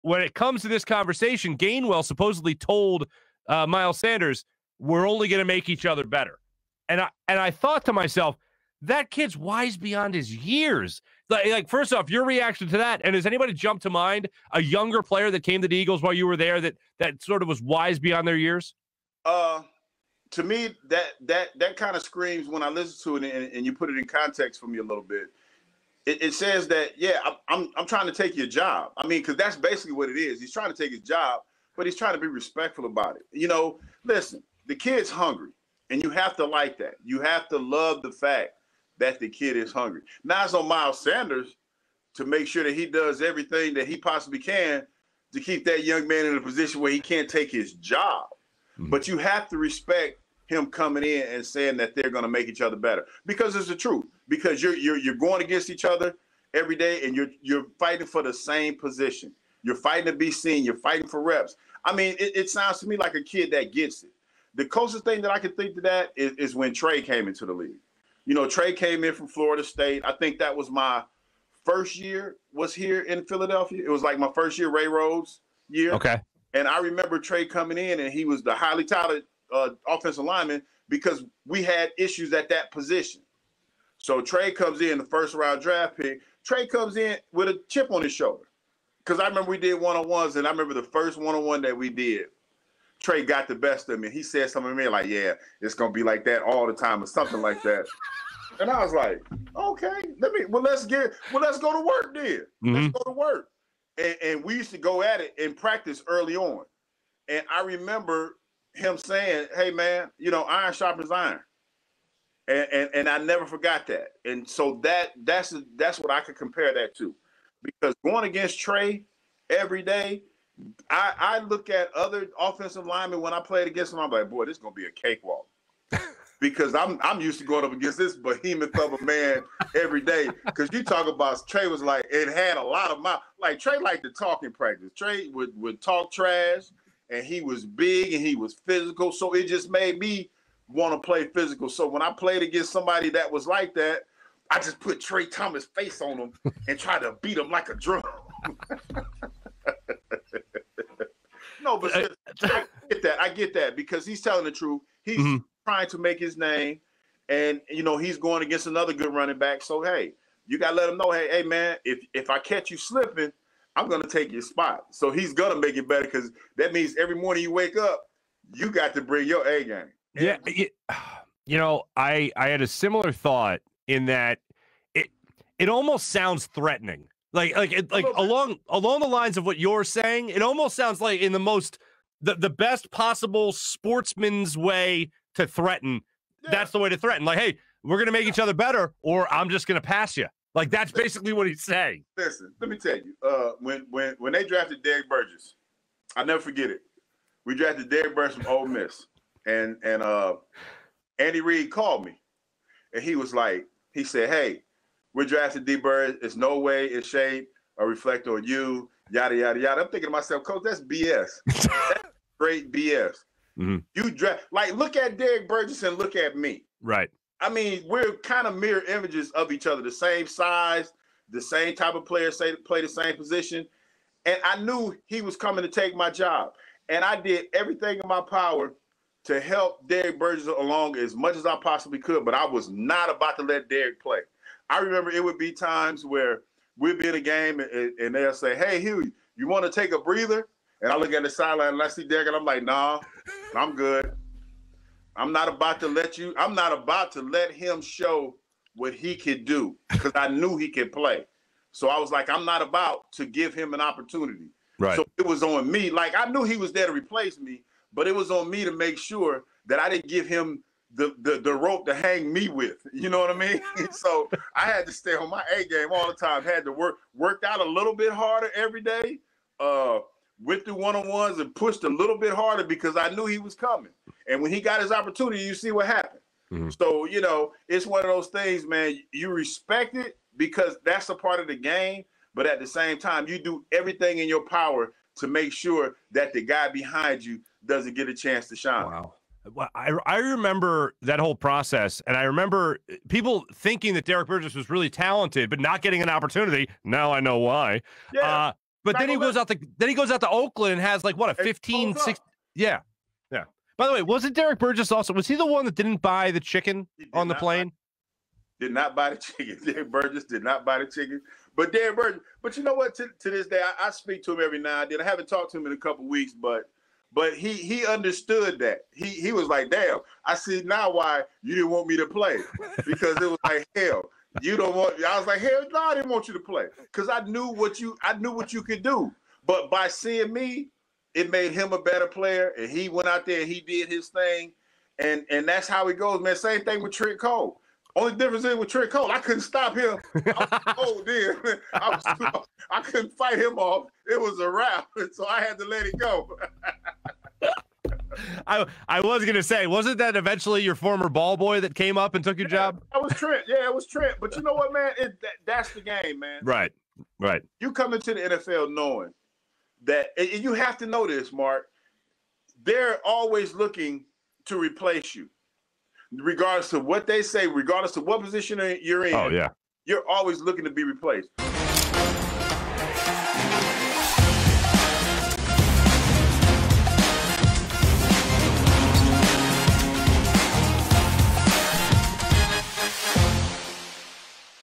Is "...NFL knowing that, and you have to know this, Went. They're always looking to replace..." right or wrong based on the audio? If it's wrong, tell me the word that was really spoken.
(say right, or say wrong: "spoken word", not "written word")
wrong: "Marc", not "Went".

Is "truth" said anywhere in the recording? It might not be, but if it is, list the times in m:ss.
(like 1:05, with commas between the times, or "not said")
0:53, 2:34.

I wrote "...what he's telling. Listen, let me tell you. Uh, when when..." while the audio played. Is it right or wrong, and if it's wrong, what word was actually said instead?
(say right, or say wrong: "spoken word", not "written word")
wrong: "saying", not "telling".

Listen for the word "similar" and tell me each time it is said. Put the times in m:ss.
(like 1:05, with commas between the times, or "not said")
2:52.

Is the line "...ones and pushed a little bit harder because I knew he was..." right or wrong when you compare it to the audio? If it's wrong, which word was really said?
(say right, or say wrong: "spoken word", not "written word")
right.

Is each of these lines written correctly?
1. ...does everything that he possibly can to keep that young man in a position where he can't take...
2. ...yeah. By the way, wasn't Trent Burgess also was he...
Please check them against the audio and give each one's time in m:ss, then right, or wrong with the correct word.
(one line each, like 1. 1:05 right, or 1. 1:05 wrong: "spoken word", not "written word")
1. 0:42 right
2. 5:03 wrong: "Derrick", not "Trent".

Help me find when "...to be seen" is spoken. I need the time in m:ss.
1:00.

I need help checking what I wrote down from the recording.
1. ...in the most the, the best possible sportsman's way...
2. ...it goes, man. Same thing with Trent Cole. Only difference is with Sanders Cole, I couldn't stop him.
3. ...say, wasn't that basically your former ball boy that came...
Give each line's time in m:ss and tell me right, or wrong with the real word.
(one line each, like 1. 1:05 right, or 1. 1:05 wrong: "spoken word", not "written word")
1. 3:01 right
2. 5:35 wrong: "Trent", not "Sanders"
3. 5:49 wrong: "eventually", not "basically".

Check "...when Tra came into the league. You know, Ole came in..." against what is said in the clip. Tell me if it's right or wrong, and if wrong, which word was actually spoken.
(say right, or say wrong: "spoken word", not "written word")
wrong: "Tra", not "Ole".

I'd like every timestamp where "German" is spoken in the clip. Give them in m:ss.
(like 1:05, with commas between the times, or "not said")
not said.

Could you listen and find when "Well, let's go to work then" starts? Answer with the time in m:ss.
1:41.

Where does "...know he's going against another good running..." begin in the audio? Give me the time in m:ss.
2:37.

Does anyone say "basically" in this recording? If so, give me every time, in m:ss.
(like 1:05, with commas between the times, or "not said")
0:29, 3:10.